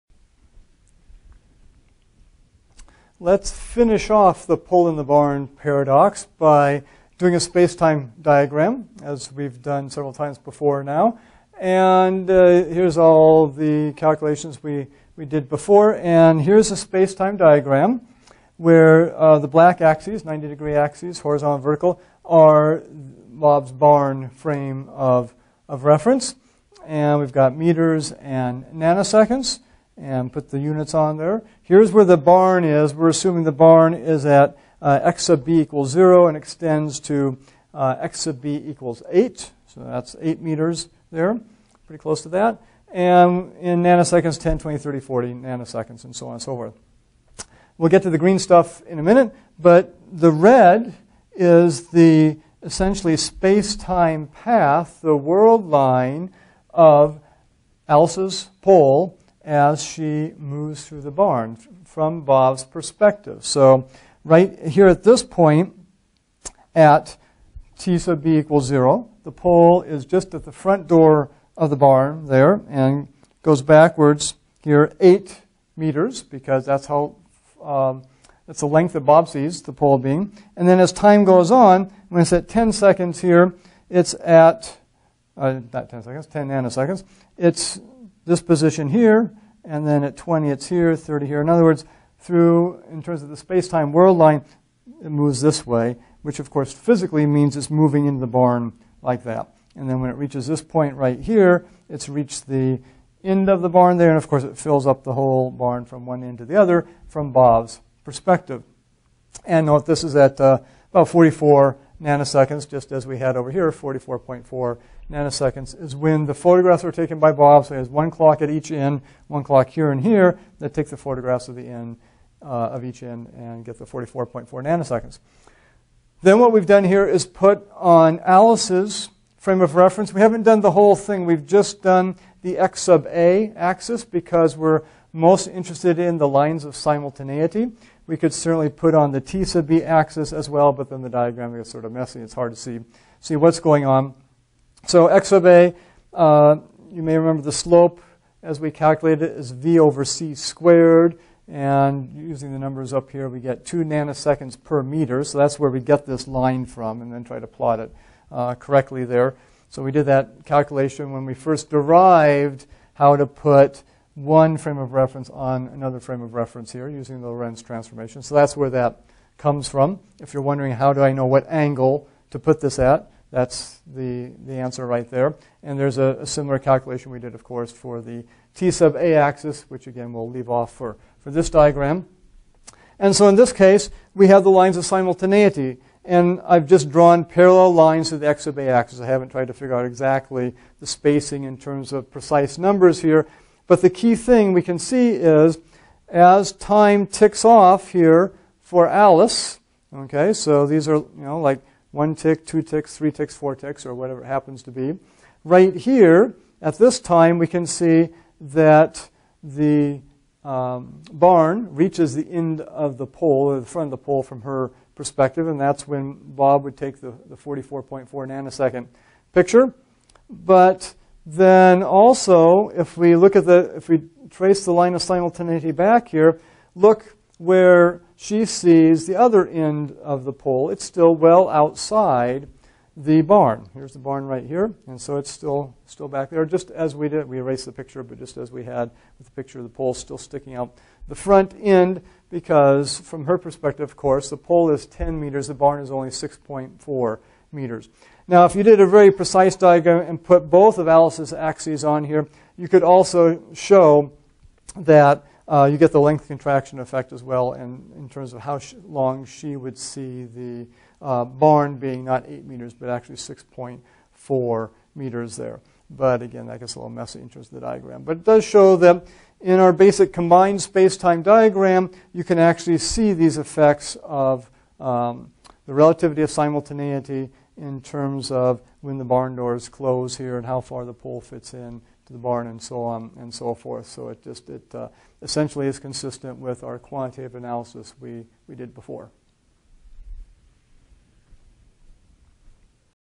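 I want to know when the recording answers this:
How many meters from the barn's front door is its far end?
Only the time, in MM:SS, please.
00:37.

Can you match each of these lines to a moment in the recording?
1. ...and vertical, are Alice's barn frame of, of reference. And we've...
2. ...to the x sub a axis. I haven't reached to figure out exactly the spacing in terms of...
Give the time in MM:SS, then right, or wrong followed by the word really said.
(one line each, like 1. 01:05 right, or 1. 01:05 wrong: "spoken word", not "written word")
1. 00:21 wrong: "Bob", not "Alice"
2. 03:08 wrong: "tried", not "reached".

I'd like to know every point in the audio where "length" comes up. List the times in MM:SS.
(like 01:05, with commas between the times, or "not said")
01:18, 04:15.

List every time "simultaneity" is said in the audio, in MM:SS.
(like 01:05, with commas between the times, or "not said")
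02:16, 03:04, 03:45, 04:36.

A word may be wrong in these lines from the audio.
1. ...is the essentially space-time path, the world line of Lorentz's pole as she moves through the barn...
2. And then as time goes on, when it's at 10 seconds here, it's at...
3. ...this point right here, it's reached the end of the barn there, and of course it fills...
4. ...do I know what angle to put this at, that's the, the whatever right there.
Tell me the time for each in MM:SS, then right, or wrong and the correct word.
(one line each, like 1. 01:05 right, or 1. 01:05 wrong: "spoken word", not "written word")
1. 00:51 wrong: "Alice", not "Lorentz"
2. 01:20 right
3. 01:40 right
4. 02:50 wrong: "answer", not "whatever".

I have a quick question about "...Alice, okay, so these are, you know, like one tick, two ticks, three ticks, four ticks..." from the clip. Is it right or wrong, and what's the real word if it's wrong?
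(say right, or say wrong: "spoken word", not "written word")
right.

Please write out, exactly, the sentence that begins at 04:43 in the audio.
So it just it uh, essentially is consistent with our quantitative analysis we, we did before.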